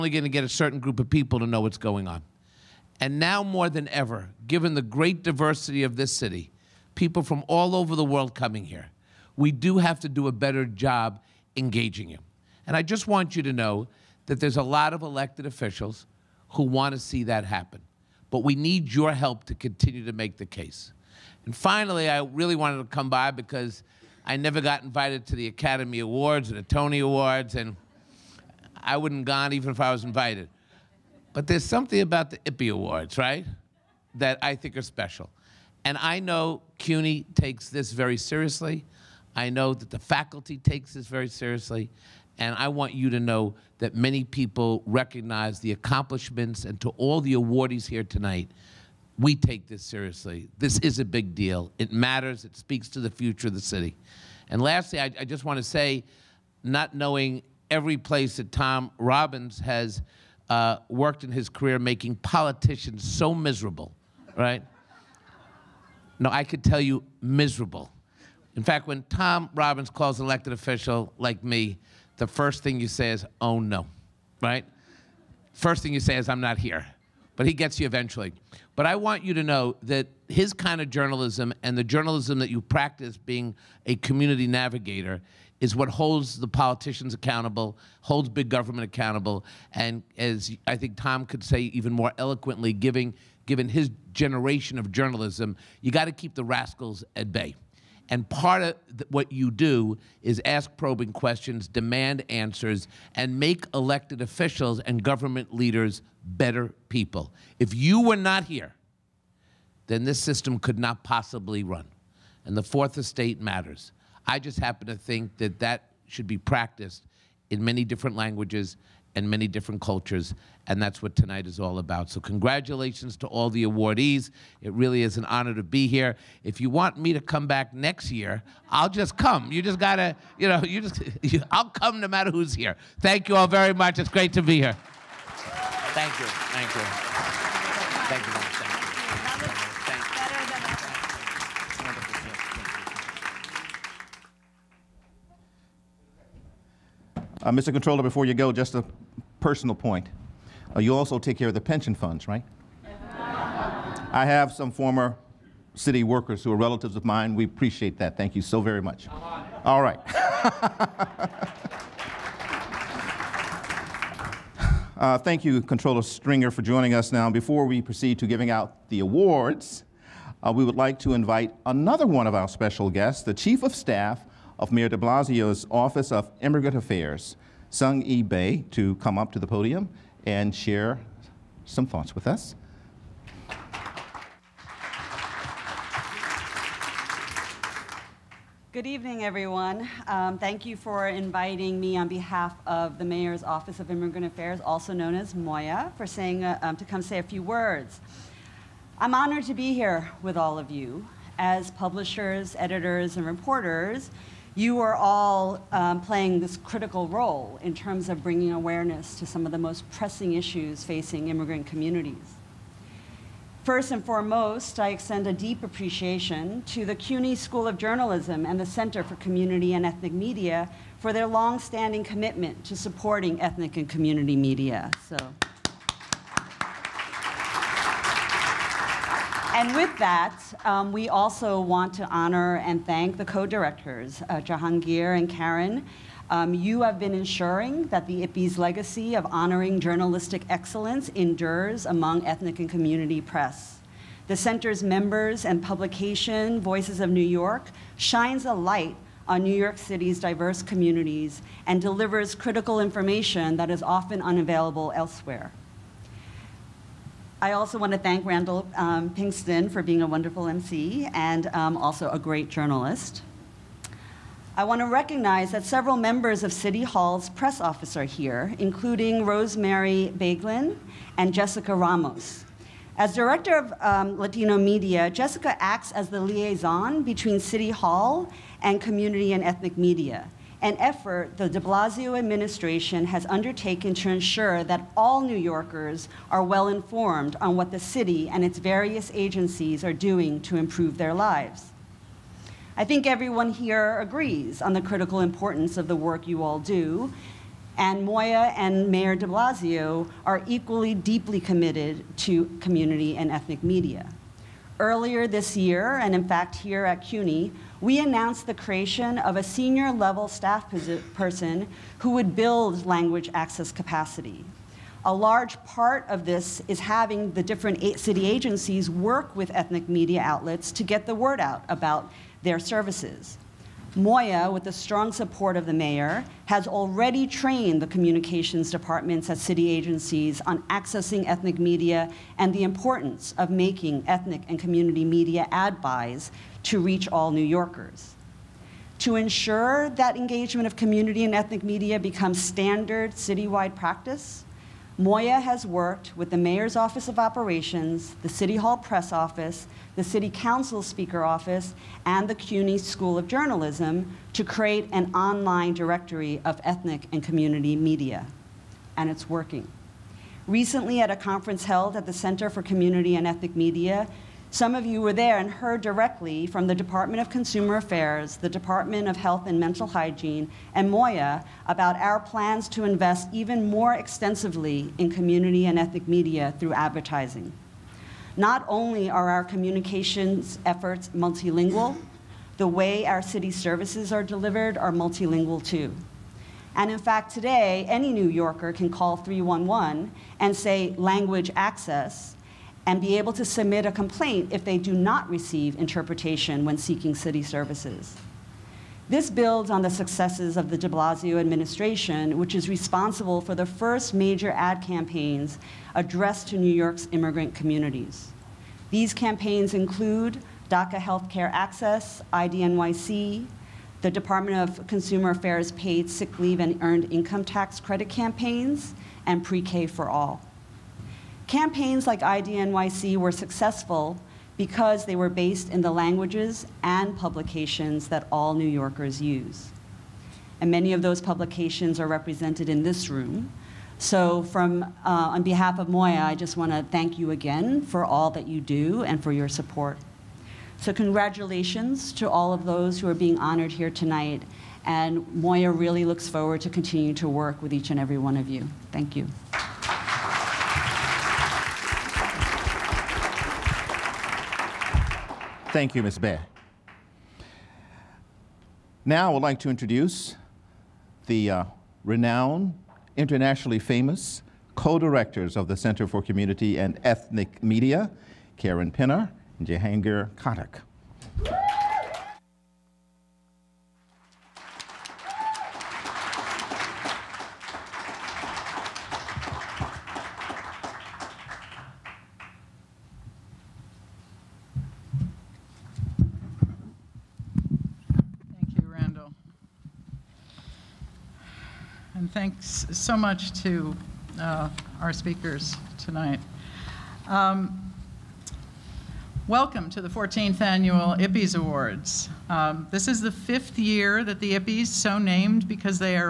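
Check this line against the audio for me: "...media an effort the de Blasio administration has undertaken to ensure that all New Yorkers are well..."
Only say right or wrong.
right.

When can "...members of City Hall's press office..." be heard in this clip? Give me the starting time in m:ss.
4:25.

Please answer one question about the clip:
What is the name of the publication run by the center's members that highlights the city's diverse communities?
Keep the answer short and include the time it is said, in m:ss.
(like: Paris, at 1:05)
Voices of New York, at 4:06.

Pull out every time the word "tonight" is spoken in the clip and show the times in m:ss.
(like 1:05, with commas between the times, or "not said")
0:48, 2:01, 7:23, 8:15.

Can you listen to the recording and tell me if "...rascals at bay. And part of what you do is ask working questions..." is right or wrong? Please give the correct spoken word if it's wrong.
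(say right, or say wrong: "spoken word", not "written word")
wrong: "probing", not "working".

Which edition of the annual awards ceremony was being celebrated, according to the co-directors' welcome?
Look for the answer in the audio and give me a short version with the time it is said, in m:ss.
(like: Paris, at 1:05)
14th, at 8:20.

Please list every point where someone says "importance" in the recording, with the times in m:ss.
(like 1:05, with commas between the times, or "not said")
4:55, 5:32.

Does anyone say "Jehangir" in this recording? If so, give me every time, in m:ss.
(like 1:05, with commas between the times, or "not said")
3:54, 7:49.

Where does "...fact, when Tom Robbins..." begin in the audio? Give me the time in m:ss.
1:08.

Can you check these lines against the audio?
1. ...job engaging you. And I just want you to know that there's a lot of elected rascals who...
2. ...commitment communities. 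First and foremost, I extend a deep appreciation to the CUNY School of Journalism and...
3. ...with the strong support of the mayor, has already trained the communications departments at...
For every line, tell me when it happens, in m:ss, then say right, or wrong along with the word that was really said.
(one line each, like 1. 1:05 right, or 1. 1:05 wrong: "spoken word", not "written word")
1. 0:10 wrong: "officials", not "rascals"
2. 3:31 wrong: "immigrant", not "commitment"
3. 5:24 right.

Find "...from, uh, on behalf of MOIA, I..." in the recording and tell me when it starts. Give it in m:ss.
7:14.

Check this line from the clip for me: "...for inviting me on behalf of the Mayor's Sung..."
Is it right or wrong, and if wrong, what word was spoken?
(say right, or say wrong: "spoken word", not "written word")
wrong: "Office", not "Sung".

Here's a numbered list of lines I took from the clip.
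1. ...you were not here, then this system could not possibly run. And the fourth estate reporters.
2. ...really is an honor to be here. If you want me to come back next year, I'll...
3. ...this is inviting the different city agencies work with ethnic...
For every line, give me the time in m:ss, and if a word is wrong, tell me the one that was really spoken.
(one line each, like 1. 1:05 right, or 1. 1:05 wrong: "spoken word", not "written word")
1. 1:47 wrong: "matters", not "reporters"
2. 2:04 right
3. 5:16 wrong: "having", not "inviting".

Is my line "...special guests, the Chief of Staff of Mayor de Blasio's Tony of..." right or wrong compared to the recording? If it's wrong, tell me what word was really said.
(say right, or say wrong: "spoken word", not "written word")
wrong: "Office", not "Tony".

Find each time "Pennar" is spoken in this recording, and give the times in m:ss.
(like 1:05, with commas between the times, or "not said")
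7:48.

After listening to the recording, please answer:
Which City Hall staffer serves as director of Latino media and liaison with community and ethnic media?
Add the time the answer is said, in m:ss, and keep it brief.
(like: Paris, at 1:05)
Jessica Ramos, at 4:31.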